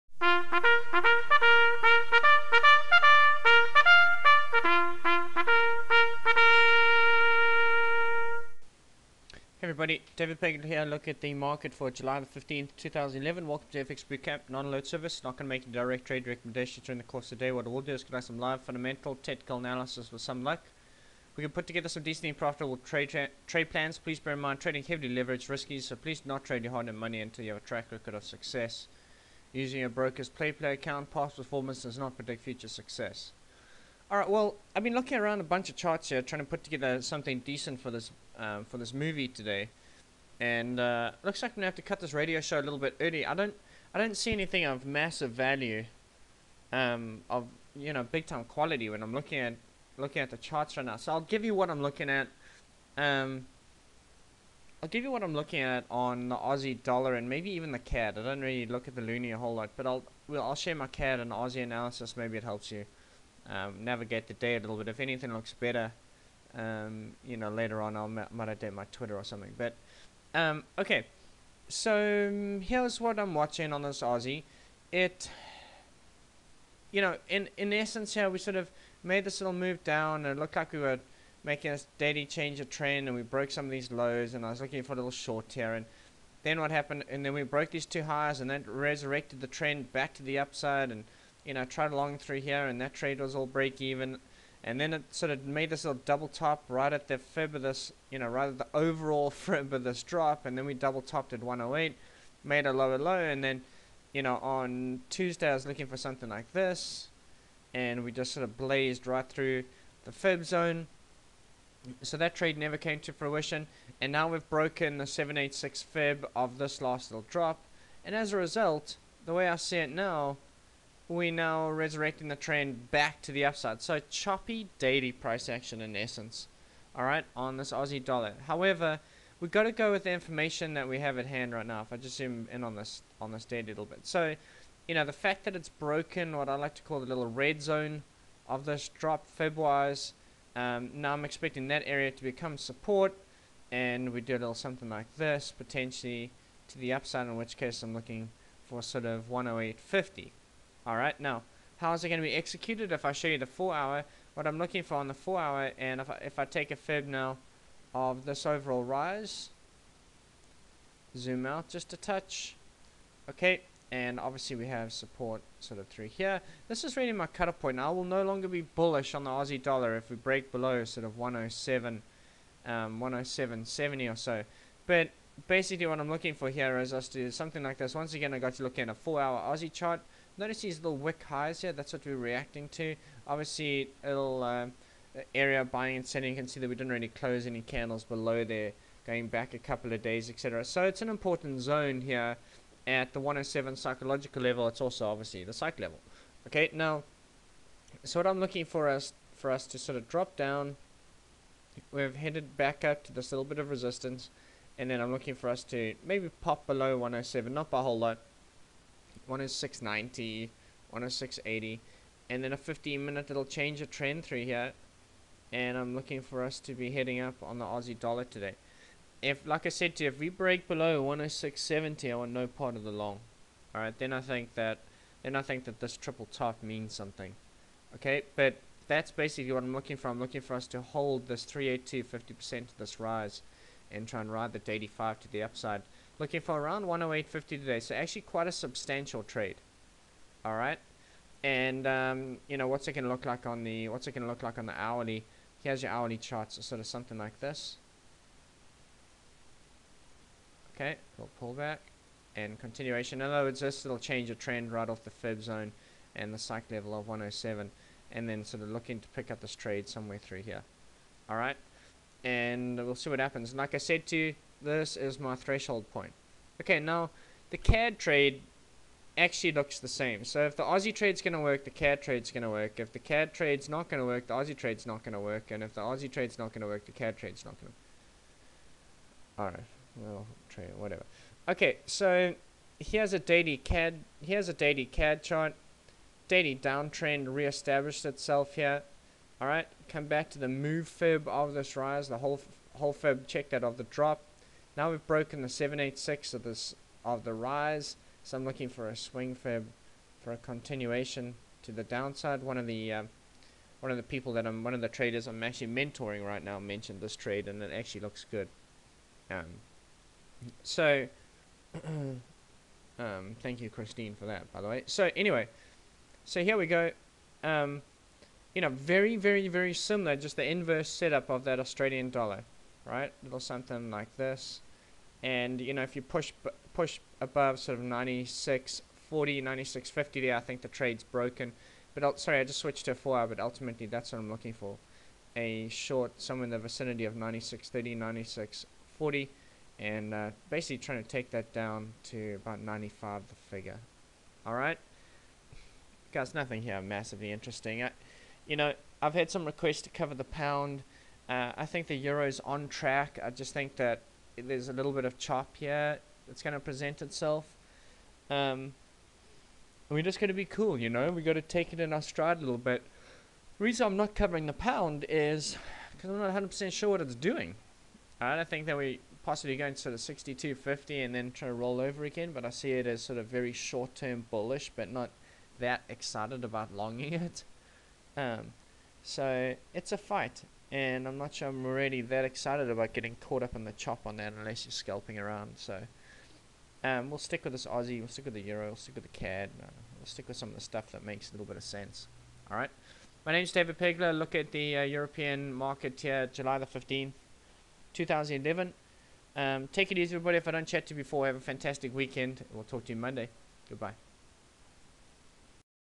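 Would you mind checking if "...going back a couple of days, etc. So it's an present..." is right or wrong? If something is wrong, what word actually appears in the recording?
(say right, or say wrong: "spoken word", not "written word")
wrong: "important", not "present".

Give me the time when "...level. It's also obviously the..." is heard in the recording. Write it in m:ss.
3:14.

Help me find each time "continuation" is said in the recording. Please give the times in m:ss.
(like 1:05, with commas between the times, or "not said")
4:12, 5:00.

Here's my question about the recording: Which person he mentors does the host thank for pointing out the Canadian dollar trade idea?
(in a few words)
Christine.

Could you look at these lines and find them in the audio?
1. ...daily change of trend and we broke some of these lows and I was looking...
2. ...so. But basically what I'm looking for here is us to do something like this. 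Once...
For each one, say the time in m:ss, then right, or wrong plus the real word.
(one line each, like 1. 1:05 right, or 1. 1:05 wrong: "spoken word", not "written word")
1. 1:21 right
2. 2:54 right.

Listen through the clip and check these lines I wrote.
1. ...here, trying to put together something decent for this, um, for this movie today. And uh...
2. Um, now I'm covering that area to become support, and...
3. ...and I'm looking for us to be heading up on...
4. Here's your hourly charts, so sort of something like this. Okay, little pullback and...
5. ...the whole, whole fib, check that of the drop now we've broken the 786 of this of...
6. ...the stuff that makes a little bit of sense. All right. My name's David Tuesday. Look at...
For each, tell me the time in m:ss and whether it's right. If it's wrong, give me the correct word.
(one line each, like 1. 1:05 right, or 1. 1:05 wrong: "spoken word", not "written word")
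1. 0:36 right
2. 2:20 wrong: "expecting", not "covering"
3. 3:35 right
4. 4:05 right
5. 4:52 right
6. 6:30 wrong: "Pegler", not "Tuesday".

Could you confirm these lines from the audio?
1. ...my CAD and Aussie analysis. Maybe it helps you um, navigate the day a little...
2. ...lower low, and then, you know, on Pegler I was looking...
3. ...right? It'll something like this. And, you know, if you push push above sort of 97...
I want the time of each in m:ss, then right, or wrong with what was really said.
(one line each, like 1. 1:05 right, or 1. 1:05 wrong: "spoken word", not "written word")
1. 1:00 right
2. 1:42 wrong: "Tuesday", not "Pegler"
3. 5:22 wrong: "96", not "97".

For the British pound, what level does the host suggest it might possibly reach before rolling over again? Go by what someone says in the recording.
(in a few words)
62.50.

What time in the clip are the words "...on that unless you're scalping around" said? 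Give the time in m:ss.
6:24.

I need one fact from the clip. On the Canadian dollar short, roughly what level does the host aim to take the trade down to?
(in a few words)
95.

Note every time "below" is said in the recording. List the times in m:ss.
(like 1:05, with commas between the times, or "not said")
2:50, 3:08, 3:26, 3:40.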